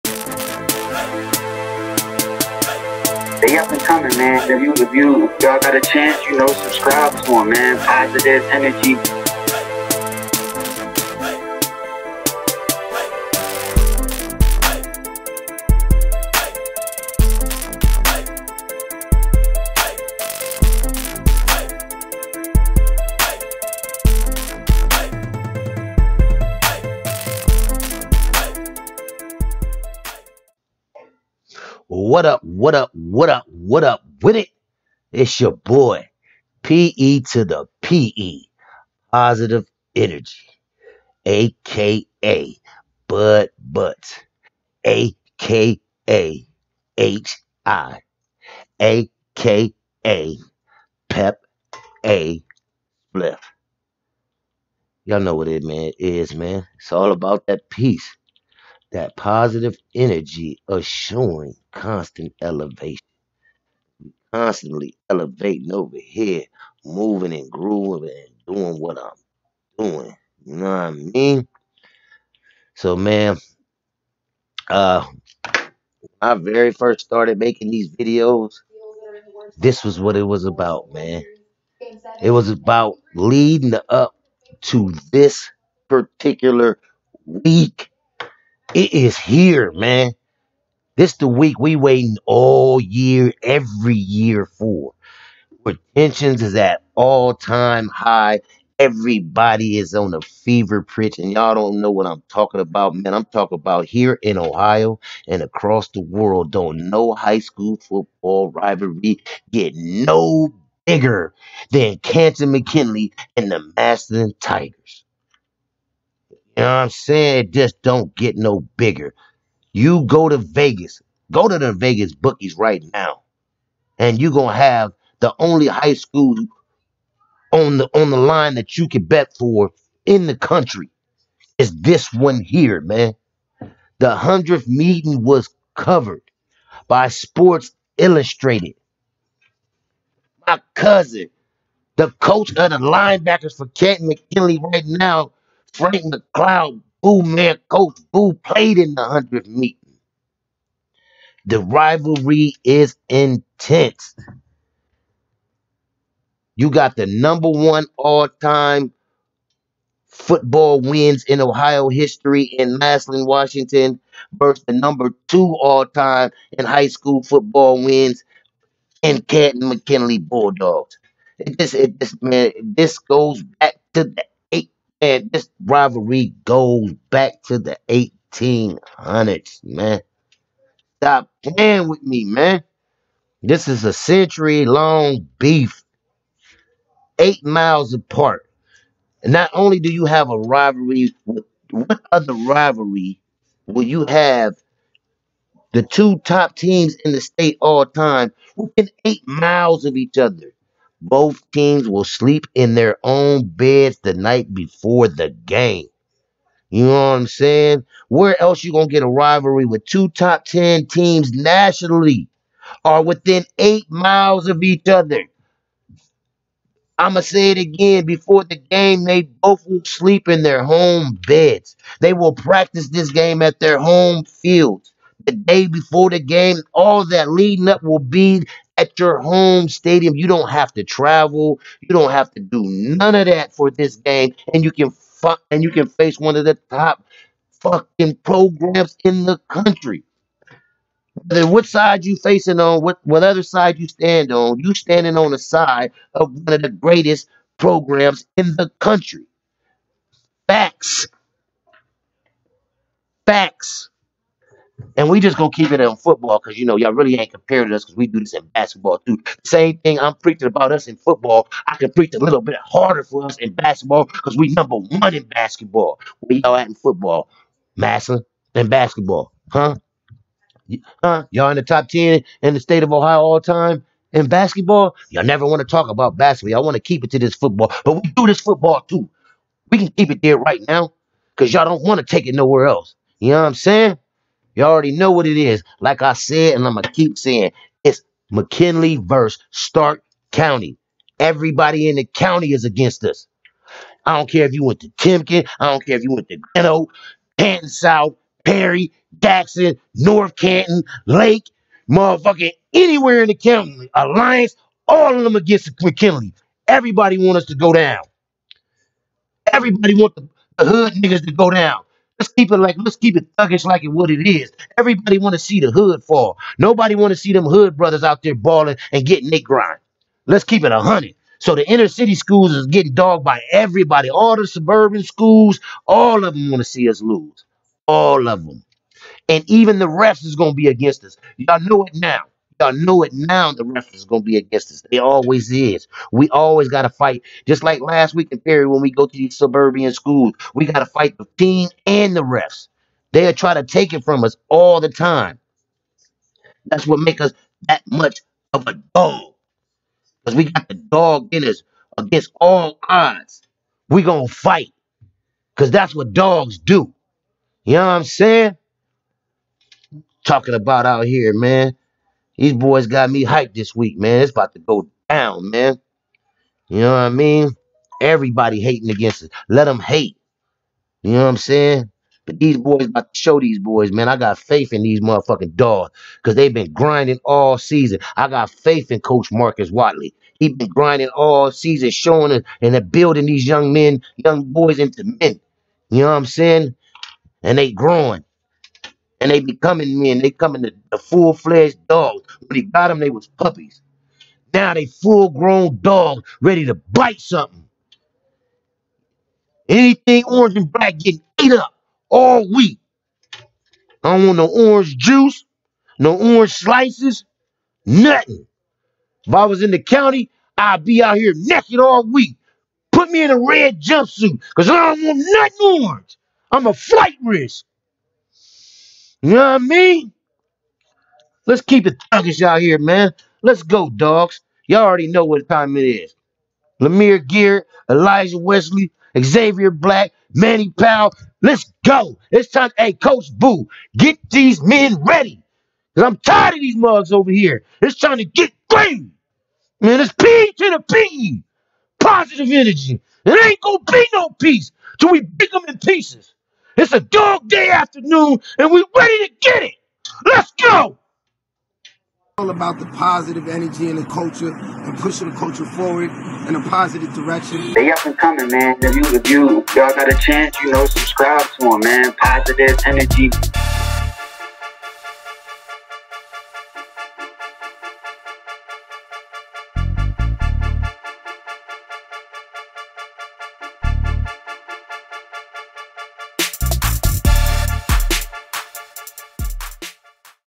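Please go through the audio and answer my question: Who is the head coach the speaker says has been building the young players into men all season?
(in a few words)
Marcus Watley.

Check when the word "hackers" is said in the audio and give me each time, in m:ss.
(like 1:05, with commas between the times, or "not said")
not said.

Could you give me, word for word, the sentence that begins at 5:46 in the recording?
That's what makes us that much of a dog.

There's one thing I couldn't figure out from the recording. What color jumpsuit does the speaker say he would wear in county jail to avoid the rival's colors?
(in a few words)
Red.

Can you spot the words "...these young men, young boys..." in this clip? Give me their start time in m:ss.
6:23.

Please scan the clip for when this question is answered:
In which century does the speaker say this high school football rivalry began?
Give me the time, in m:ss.
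2:57.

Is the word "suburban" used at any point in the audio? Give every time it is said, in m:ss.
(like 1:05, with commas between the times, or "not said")
5:24, 5:39.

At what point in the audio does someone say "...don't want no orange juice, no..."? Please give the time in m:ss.
6:44.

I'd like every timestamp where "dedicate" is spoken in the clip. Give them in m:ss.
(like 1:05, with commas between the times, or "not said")
not said.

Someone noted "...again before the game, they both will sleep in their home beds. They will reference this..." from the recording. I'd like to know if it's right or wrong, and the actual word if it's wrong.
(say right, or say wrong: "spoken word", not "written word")
wrong: "practice", not "reference".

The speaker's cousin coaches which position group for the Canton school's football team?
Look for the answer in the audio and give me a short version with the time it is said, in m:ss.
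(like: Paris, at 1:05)
Linebackers, at 2:22.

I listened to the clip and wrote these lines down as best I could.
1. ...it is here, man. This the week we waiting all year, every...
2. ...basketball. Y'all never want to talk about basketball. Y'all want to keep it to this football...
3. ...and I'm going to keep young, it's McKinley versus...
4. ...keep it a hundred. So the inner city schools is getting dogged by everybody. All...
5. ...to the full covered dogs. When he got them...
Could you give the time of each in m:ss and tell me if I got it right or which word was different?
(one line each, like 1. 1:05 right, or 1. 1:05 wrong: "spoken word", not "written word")
1. 1:28 right
2. 4:34 right
3. 4:46 wrong: "saying", not "young"
4. 5:20 right
5. 6:30 wrong: "fledged", not "covered".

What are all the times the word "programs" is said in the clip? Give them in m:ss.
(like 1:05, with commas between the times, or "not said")
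3:58, 4:07.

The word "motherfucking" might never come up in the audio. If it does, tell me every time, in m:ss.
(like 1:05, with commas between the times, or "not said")
5:01, 6:15.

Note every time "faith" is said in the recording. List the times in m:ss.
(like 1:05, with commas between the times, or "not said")
6:14, 6:18.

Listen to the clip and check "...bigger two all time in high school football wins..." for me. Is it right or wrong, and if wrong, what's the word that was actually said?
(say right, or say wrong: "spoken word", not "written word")
wrong: "number", not "bigger".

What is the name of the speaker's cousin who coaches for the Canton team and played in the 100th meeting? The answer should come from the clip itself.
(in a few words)
Frank McLeod.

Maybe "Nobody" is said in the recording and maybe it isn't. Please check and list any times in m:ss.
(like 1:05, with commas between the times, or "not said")
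5:16.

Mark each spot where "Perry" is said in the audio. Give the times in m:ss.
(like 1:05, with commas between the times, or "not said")
4:58, 5:38.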